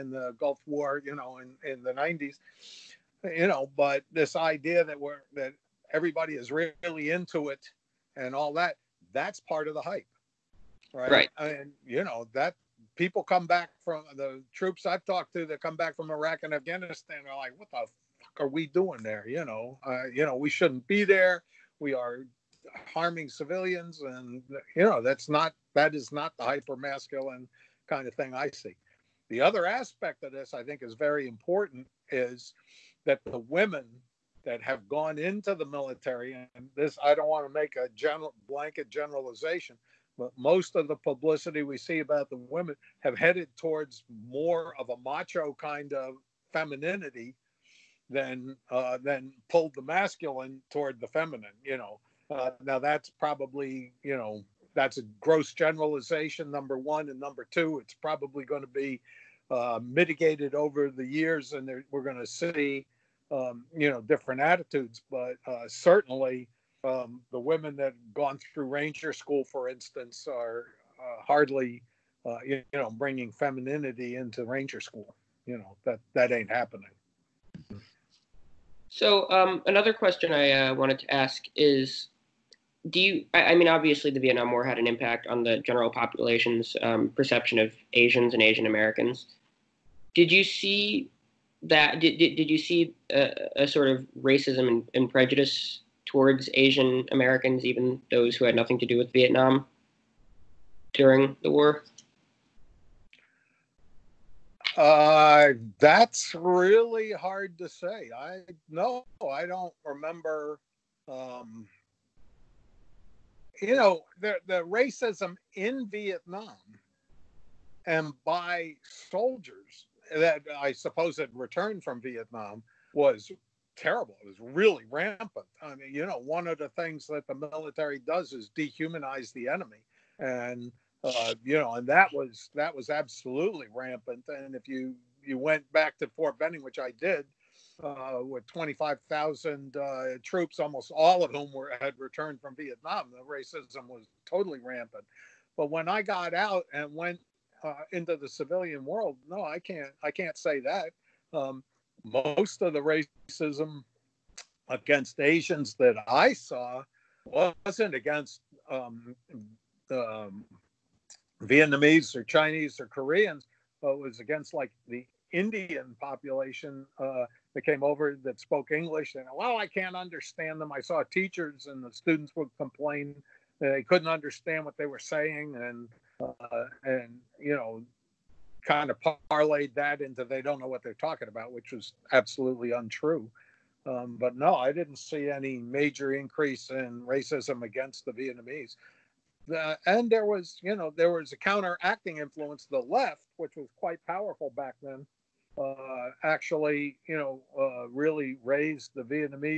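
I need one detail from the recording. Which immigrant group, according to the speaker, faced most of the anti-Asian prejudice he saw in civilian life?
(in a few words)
Indian population.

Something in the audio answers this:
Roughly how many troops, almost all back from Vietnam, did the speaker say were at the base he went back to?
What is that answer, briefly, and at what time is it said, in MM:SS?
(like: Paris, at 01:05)
25,000, at 02:18.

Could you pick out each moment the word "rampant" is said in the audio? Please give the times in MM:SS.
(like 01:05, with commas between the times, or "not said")
02:04, 02:13, 02:24.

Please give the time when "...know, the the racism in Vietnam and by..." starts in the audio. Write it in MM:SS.
01:53.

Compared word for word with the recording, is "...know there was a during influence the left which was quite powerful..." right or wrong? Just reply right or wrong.
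wrong.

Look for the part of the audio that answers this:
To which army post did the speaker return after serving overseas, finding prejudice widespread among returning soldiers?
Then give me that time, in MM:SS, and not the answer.
02:16.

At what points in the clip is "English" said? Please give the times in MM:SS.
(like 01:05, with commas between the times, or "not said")
02:48.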